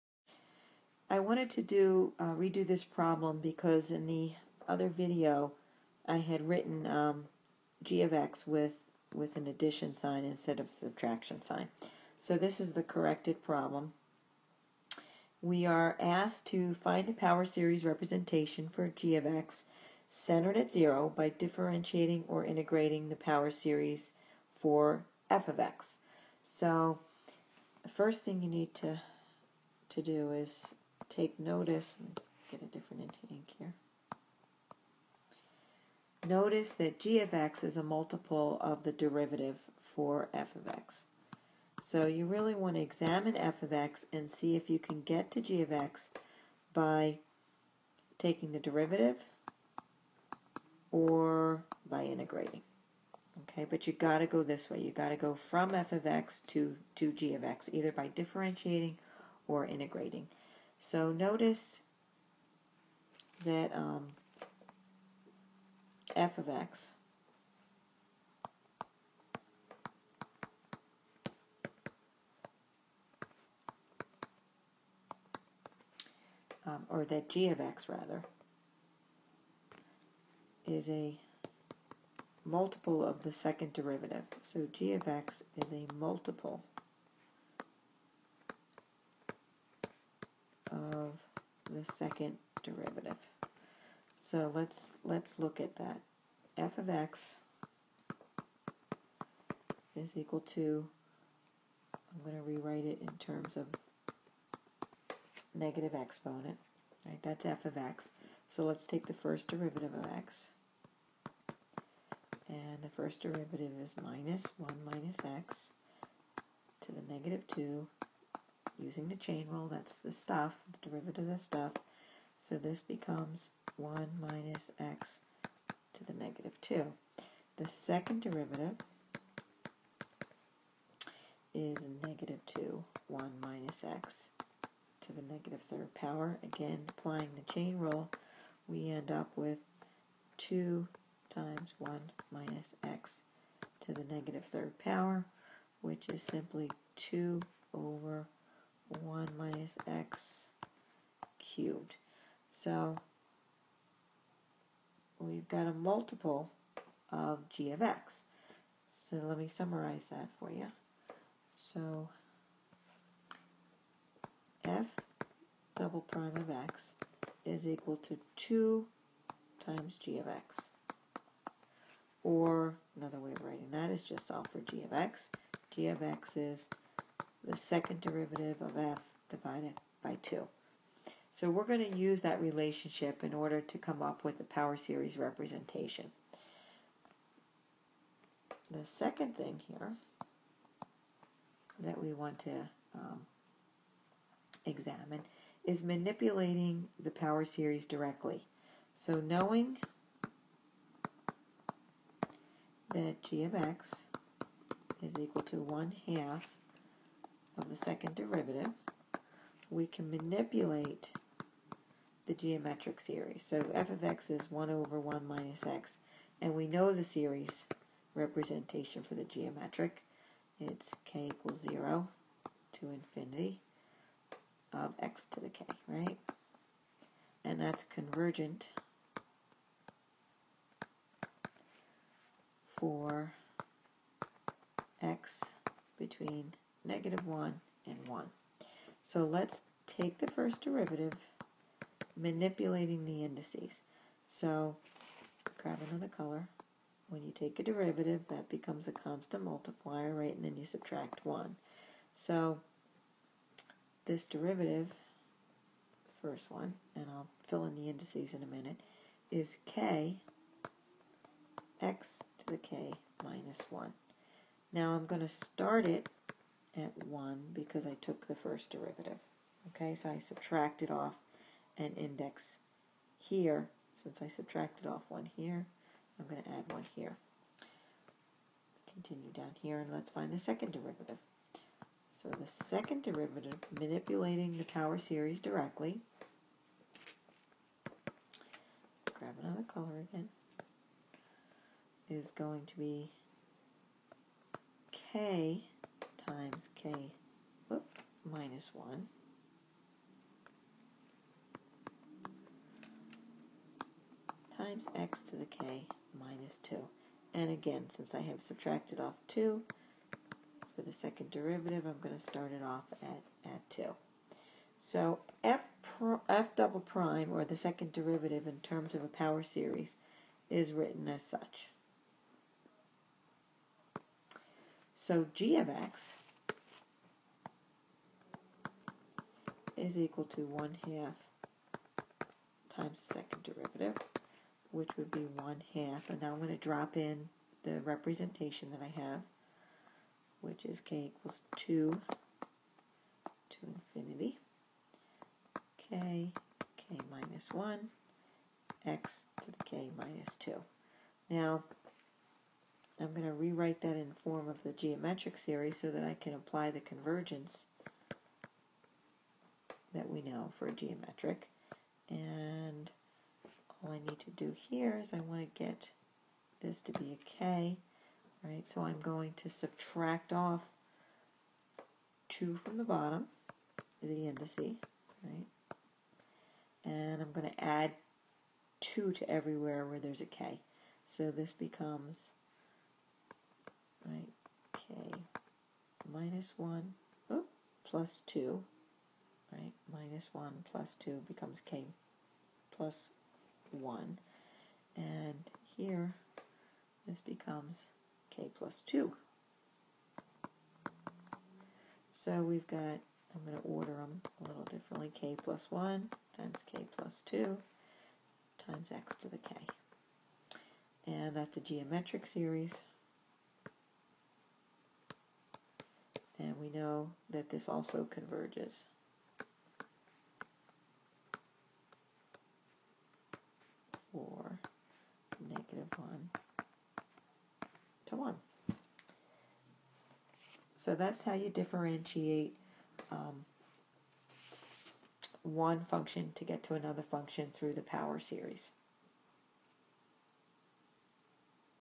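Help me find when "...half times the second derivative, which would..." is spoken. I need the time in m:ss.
5:30.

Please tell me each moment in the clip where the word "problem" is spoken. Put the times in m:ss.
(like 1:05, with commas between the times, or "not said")
0:02, 0:13.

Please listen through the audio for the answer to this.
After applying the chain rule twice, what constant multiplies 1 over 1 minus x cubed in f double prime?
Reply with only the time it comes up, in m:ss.
2:26.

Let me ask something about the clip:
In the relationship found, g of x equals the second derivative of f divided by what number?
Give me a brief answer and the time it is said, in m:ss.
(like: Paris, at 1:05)
2, at 2:59.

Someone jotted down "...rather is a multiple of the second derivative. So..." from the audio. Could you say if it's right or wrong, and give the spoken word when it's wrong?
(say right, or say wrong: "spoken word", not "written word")
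right.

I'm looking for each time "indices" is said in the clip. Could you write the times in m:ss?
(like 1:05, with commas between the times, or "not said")
4:03, 4:17, 6:14.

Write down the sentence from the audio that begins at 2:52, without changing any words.
Or another way of writing that is just solve for g of x.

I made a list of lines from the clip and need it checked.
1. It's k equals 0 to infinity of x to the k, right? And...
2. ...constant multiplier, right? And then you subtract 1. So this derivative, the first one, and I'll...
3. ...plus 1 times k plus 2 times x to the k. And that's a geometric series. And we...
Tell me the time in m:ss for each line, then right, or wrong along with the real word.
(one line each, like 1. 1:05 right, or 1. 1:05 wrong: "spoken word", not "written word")
1. 3:40 right
2. 4:08 right
3. 6:45 right.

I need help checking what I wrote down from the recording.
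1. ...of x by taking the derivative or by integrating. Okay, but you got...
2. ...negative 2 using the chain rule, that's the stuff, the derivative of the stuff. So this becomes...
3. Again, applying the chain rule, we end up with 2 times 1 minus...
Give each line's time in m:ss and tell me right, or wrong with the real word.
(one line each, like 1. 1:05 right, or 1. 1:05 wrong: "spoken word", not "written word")
1. 0:45 right
2. 1:57 right
3. 2:16 right.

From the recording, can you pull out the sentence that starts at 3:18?
So knowing that g of x is equal to 1 half the second derivative, we can manipulate the geometric series.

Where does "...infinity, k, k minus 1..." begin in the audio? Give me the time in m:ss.
5:43.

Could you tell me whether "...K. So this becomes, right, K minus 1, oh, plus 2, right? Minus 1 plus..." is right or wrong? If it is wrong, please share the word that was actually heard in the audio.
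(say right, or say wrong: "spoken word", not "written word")
right.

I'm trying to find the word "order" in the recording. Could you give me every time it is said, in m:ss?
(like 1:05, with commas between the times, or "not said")
3:03, 6:43.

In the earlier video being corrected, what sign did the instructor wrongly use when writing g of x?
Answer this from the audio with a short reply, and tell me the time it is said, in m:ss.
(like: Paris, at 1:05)
addition sign, at 0:09.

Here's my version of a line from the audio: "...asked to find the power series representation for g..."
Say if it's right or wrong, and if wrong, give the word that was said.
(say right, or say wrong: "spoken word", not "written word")
right.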